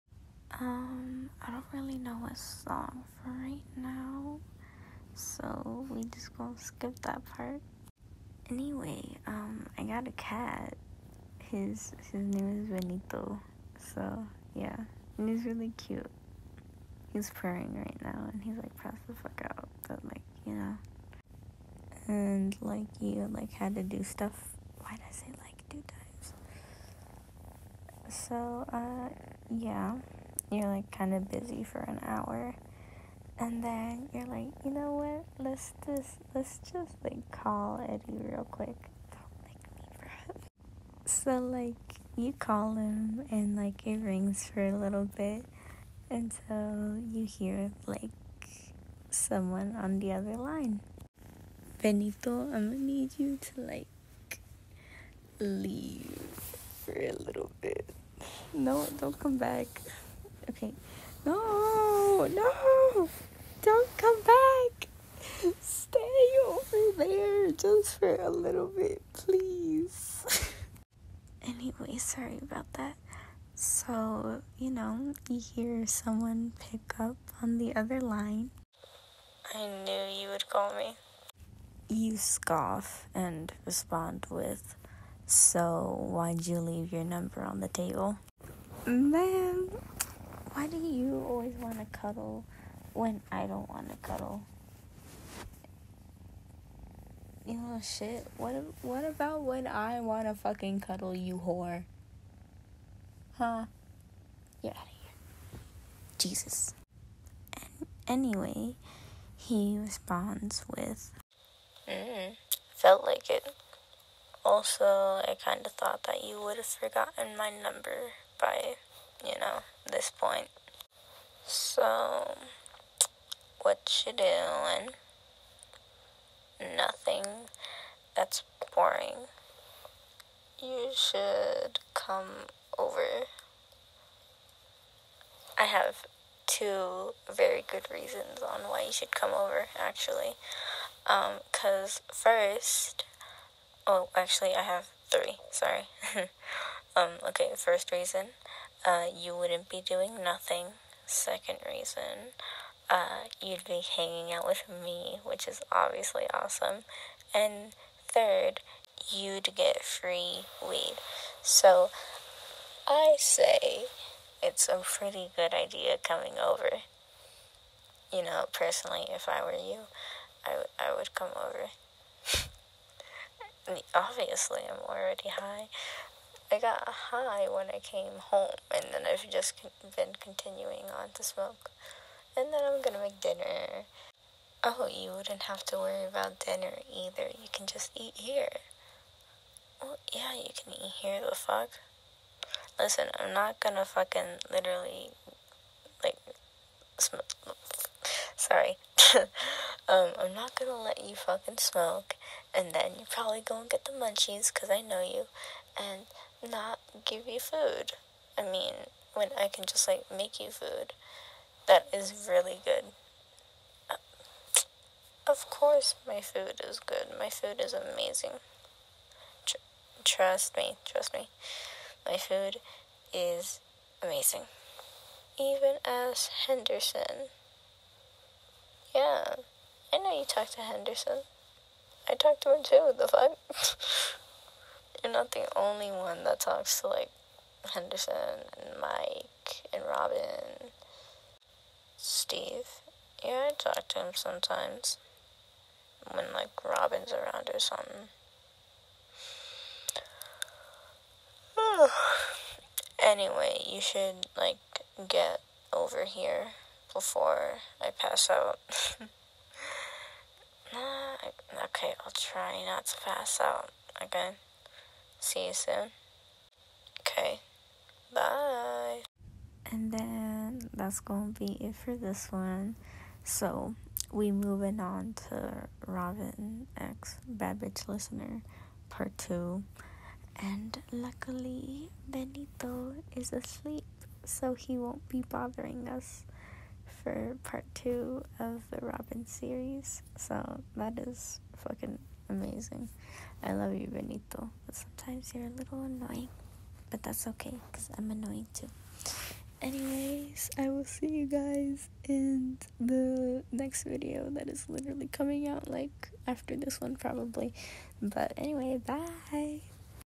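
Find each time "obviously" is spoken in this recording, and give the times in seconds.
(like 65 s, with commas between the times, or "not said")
155 s, 173 s.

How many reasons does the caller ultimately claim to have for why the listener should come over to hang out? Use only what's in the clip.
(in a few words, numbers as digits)
3.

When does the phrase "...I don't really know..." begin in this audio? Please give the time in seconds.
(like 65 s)
1 s.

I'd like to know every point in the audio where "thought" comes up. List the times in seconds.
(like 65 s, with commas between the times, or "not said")
115 s.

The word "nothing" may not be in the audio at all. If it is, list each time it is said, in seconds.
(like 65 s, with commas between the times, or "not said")
126 s, 150 s.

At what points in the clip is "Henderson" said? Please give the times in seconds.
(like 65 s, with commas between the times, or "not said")
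226 s, 230 s, 237 s.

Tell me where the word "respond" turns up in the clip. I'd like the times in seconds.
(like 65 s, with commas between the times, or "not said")
83 s, 109 s.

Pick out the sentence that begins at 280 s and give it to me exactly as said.
And luckily, Benito is asleep, so he won't be bothering us for part two of the Robin series.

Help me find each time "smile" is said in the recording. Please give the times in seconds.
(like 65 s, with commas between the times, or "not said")
not said.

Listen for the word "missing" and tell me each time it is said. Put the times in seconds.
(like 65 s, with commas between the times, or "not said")
not said.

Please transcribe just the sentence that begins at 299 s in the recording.
Anyways, I will see you guys in the next video that is literally coming out like after this one, probably.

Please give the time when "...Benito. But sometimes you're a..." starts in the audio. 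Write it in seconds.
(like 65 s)
293 s.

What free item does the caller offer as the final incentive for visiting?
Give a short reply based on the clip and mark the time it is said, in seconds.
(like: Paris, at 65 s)
Weed, at 159 s.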